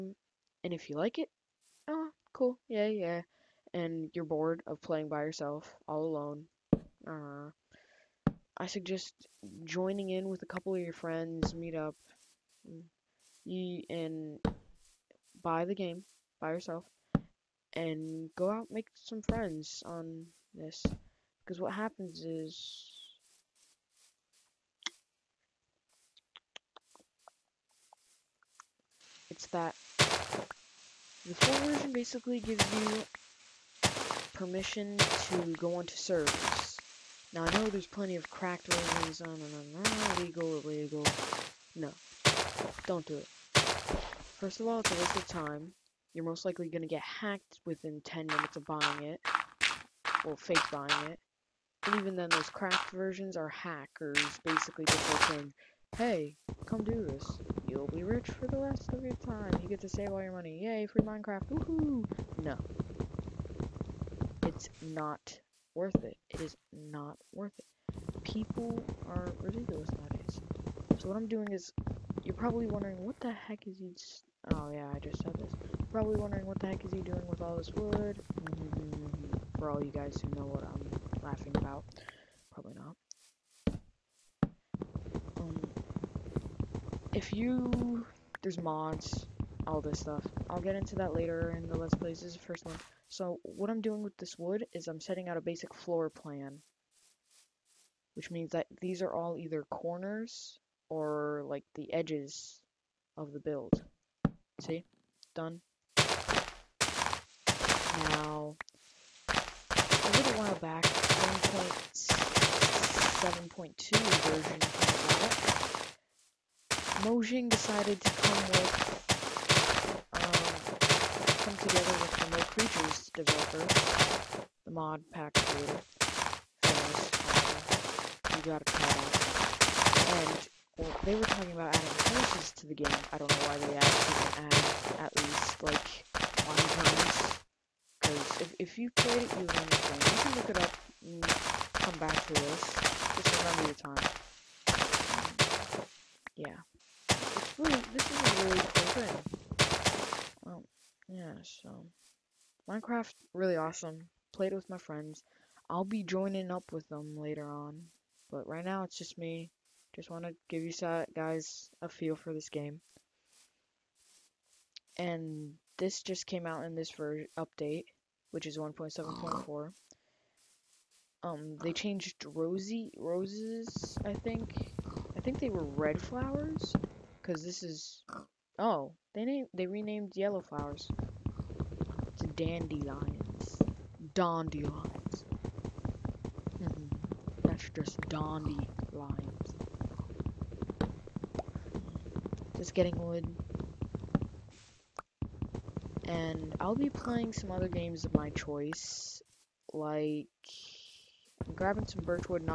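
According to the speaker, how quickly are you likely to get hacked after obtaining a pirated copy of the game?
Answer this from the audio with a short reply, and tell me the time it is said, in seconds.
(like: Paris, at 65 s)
10 minutes, at 48 s.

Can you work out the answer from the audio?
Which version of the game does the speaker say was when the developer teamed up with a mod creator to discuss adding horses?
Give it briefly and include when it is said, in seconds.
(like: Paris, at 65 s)
1.7.2, at 110 s.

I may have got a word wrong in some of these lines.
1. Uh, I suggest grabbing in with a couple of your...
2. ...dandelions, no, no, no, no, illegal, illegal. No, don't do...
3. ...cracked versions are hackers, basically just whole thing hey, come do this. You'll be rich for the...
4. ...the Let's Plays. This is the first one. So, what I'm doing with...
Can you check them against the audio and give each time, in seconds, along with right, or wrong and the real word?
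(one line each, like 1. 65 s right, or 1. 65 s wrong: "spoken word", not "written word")
1. 7 s wrong: "joining", not "grabbing"
2. 38 s wrong: "versions", not "dandelions"
3. 52 s right
4. 91 s right.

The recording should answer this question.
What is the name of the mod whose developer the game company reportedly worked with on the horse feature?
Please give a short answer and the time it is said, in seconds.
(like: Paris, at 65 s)
Mo' Creatures, at 122 s.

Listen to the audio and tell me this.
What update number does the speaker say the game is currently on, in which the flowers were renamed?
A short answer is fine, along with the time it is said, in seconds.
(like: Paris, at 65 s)
1.7.4, at 168 s.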